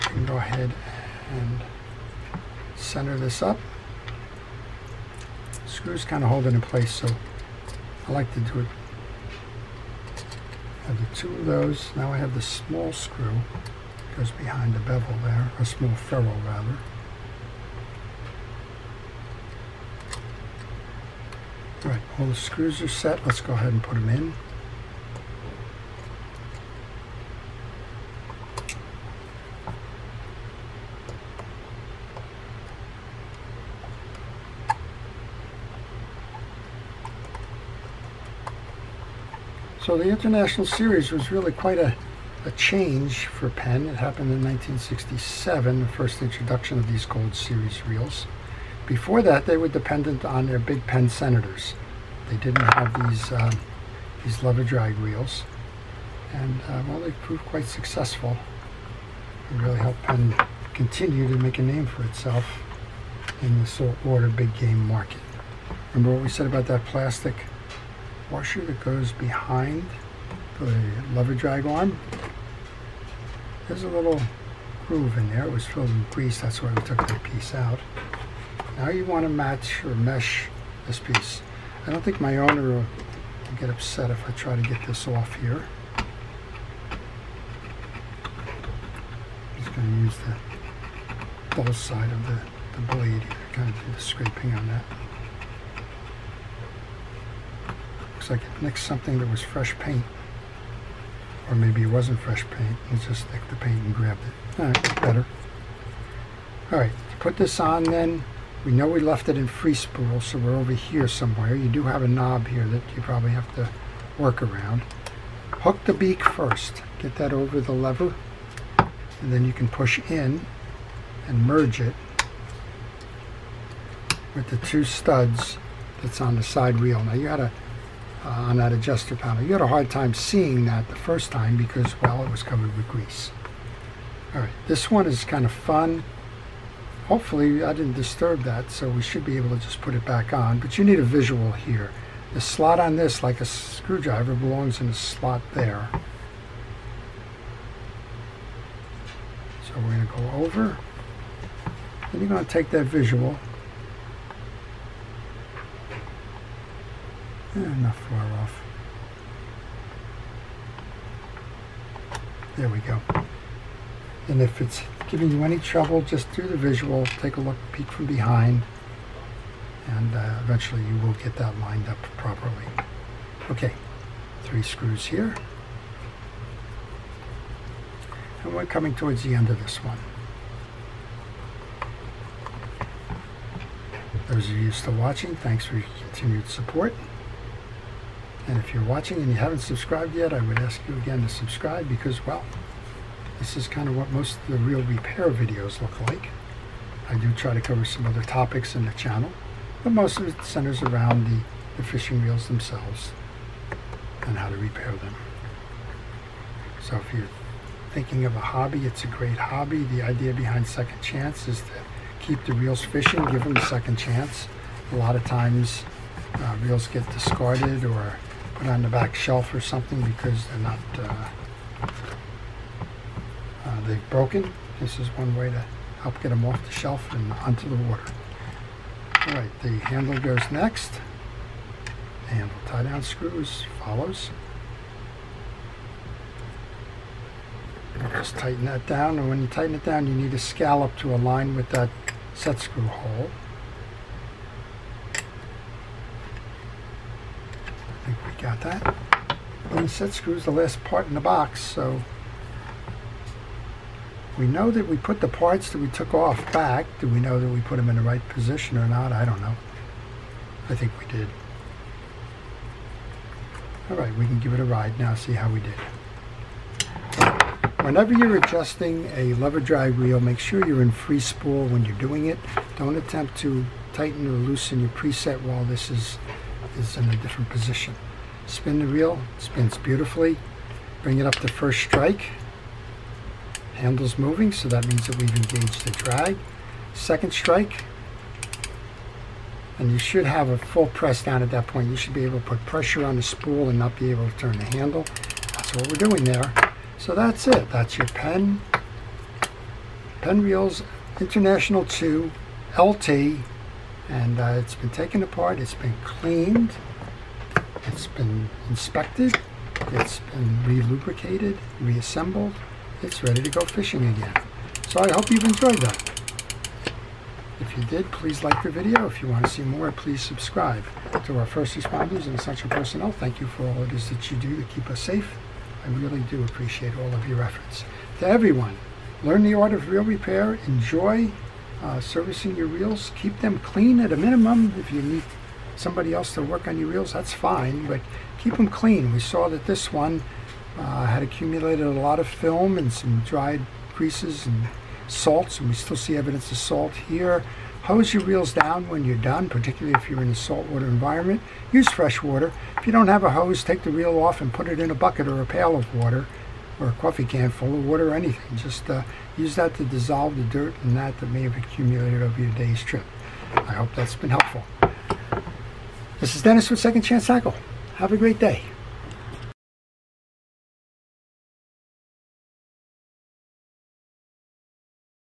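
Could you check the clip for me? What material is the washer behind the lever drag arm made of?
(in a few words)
plastic.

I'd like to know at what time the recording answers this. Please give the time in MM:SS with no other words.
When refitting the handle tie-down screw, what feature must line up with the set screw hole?
04:00.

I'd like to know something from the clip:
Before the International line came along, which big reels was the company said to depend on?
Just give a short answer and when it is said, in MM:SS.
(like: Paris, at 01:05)
Penn Senators, at 00:50.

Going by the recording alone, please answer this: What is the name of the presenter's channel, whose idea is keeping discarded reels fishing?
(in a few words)
Second Chance Tackle.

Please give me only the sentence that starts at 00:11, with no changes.
Now I have the small screw was behind the bevel there, a small ferrule rather.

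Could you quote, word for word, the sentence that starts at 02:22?
The slot on this, like a screwdriver, belongs in a slot there.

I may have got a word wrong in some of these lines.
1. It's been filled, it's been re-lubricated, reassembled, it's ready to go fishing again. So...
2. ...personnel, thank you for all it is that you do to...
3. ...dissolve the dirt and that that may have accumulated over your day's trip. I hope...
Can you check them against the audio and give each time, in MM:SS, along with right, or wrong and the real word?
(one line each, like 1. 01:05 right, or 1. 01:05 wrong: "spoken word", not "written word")
1. 05:07 wrong: "inspected", not "filled"
2. 05:22 right
3. 05:59 right.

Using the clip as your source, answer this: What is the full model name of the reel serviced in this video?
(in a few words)
International 2 LT.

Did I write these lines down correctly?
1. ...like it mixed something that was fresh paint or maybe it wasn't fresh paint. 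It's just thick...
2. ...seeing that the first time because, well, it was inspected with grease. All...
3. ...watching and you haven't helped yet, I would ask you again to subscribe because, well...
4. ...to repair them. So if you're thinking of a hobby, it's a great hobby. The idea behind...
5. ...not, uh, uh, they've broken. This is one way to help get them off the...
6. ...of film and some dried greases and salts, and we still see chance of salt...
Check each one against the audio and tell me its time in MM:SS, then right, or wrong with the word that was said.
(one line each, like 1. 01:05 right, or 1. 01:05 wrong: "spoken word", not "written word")
1. 01:38 right
2. 02:10 wrong: "covered", not "inspected"
3. 03:08 wrong: "subscribed", not "helped"
4. 03:24 right
5. 03:40 right
6. 05:42 wrong: "evidence", not "chance".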